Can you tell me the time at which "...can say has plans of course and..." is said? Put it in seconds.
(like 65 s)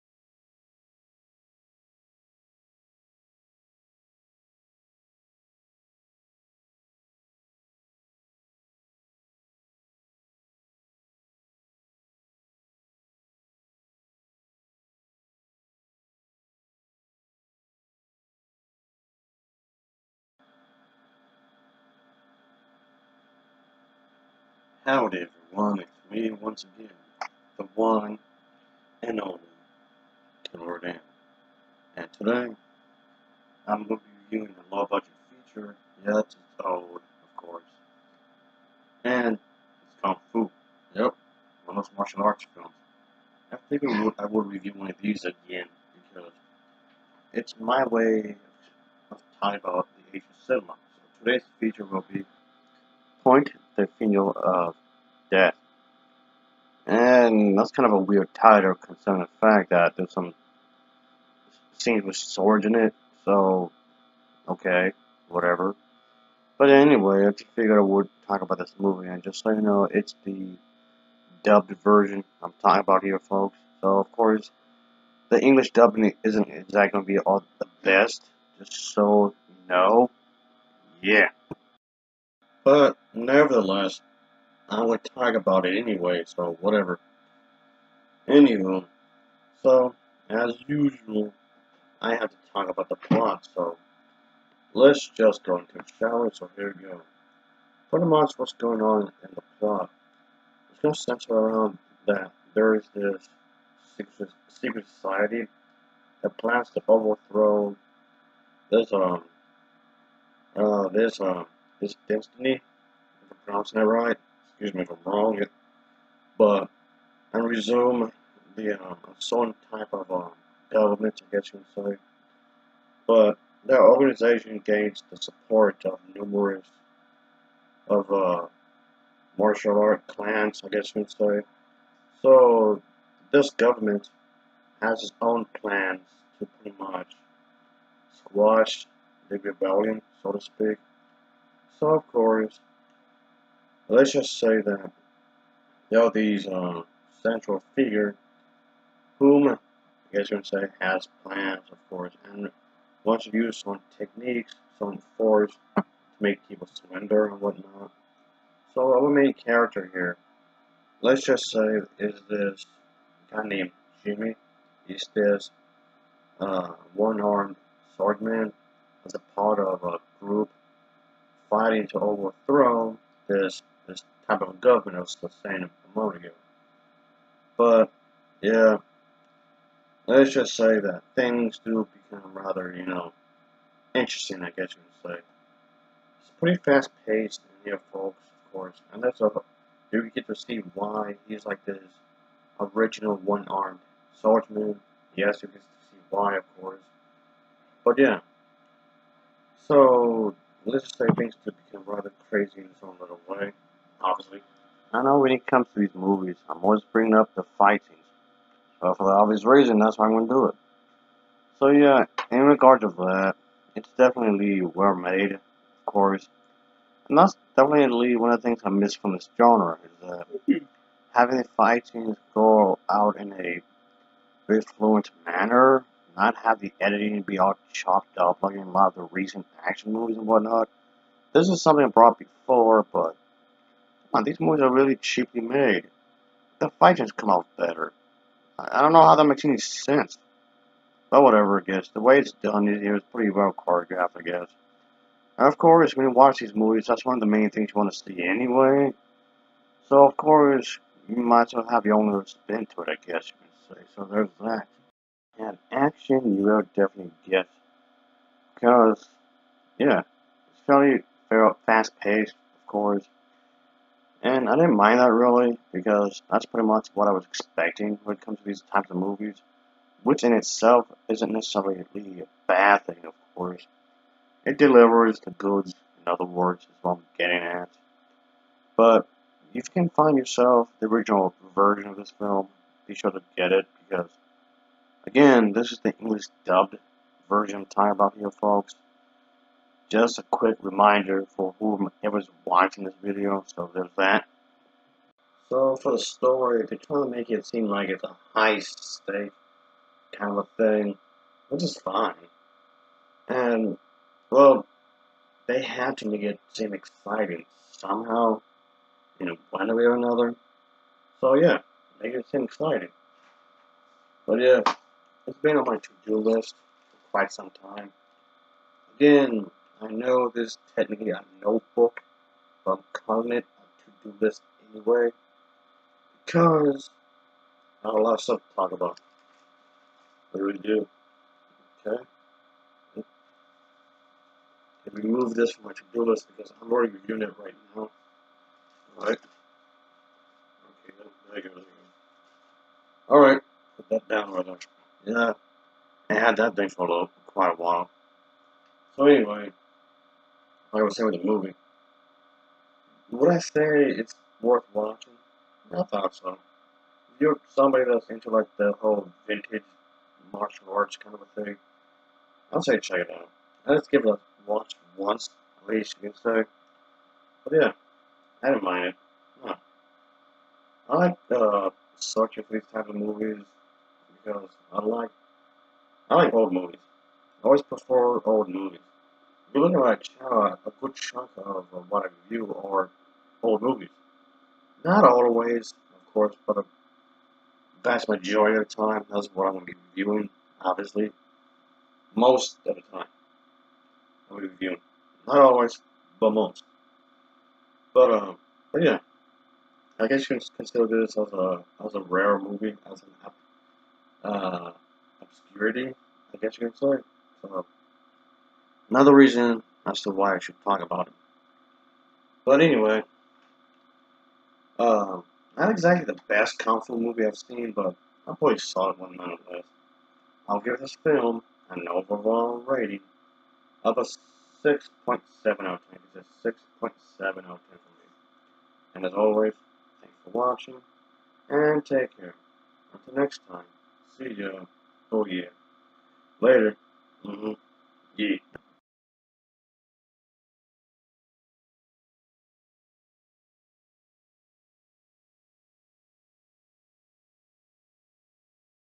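150 s.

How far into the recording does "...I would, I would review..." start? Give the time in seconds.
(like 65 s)
43 s.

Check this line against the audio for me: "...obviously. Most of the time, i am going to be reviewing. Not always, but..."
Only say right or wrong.
right.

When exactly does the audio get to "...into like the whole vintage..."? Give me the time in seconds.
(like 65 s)
358 s.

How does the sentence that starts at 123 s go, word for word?
But that organization gains the support of numerous of uh, martial art clans, I guess you would say.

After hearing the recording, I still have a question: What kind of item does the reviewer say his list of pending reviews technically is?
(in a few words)
a notebook.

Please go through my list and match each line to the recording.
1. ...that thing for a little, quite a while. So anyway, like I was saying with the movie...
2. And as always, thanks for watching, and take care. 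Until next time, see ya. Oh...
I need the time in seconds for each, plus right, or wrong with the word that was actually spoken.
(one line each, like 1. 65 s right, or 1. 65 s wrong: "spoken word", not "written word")
1. 346 s right
2. 428 s right.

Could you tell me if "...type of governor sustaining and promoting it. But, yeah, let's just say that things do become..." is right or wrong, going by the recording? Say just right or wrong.
right.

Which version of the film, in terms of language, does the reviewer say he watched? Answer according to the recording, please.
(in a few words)
English dubbed version.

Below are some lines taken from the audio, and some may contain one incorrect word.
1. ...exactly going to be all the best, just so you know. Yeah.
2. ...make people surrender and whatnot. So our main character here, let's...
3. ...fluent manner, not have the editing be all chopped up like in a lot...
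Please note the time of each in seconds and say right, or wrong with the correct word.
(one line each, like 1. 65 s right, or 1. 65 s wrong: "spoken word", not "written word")
1. 76 s right
2. 156 s right
3. 224 s right.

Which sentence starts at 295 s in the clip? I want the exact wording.
So for the story, they're trying to make it seem like it's a high stake kind of thing, which is fine.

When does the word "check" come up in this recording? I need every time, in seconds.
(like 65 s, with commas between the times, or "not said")
362 s, 380 s.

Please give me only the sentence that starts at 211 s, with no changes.
So yeah, in regards to that, it's definitely well made, of course.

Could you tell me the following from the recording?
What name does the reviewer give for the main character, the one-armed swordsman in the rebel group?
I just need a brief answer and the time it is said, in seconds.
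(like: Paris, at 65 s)
Jimmy, at 164 s.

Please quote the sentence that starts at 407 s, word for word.
So, Another reason as to why I should talk about it.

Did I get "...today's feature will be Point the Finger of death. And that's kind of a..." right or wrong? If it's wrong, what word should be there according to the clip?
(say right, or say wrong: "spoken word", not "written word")
right.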